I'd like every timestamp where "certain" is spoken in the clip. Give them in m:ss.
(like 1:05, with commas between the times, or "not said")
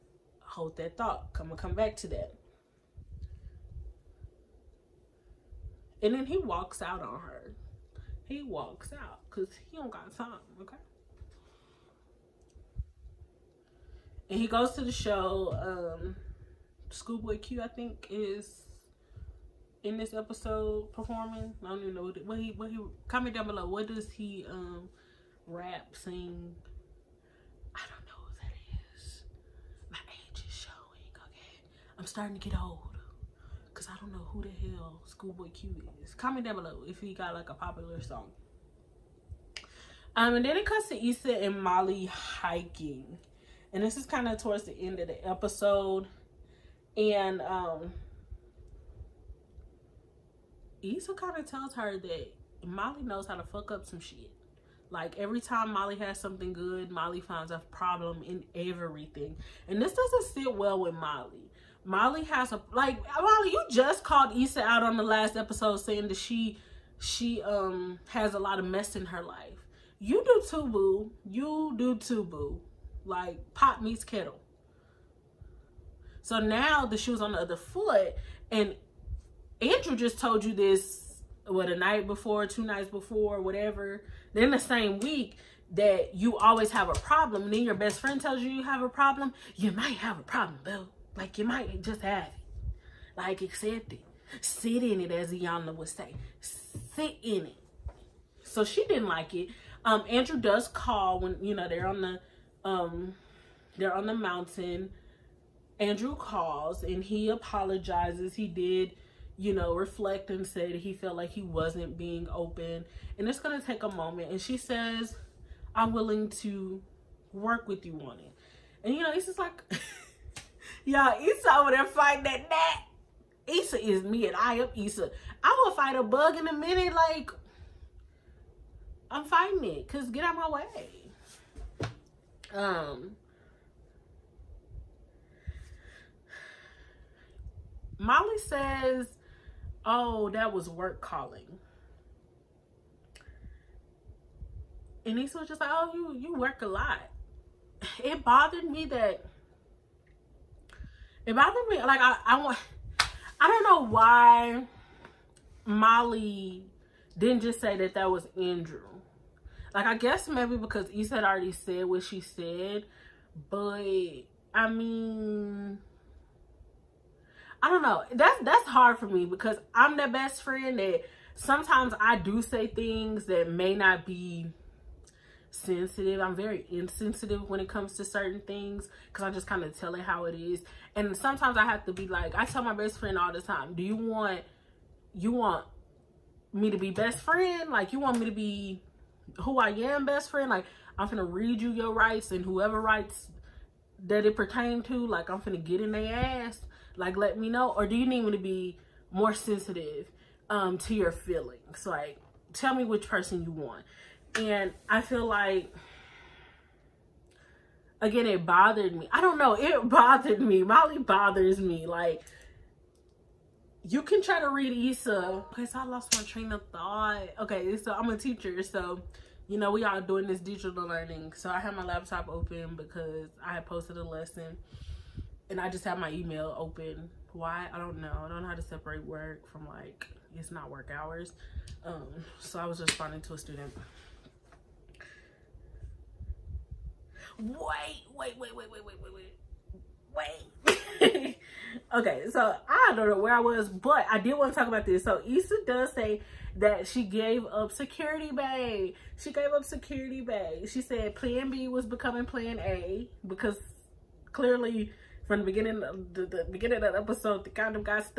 2:58.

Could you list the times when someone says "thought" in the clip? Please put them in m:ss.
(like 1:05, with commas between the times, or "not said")
0:00, 3:36.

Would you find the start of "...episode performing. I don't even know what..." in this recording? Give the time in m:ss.
0:20.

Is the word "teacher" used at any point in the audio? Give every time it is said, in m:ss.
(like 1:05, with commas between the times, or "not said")
3:38.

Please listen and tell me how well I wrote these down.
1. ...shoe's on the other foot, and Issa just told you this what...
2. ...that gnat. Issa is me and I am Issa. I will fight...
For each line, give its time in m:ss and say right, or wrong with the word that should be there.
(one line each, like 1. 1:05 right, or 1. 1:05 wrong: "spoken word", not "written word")
1. 1:16 wrong: "Andrew", not "Issa"
2. 2:02 right.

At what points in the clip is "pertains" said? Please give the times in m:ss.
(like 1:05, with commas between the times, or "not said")
3:14.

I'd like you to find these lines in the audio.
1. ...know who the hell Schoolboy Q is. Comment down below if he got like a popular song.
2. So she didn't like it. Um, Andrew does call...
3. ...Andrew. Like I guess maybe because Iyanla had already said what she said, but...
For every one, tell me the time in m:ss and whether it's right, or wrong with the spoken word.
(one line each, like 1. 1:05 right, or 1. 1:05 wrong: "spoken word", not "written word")
1. 0:34 right
2. 1:38 right
3. 2:38 wrong: "Issa", not "Iyanla".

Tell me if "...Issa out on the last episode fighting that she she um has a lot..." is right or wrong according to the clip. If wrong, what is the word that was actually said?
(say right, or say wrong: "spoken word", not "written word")
wrong: "saying", not "fighting".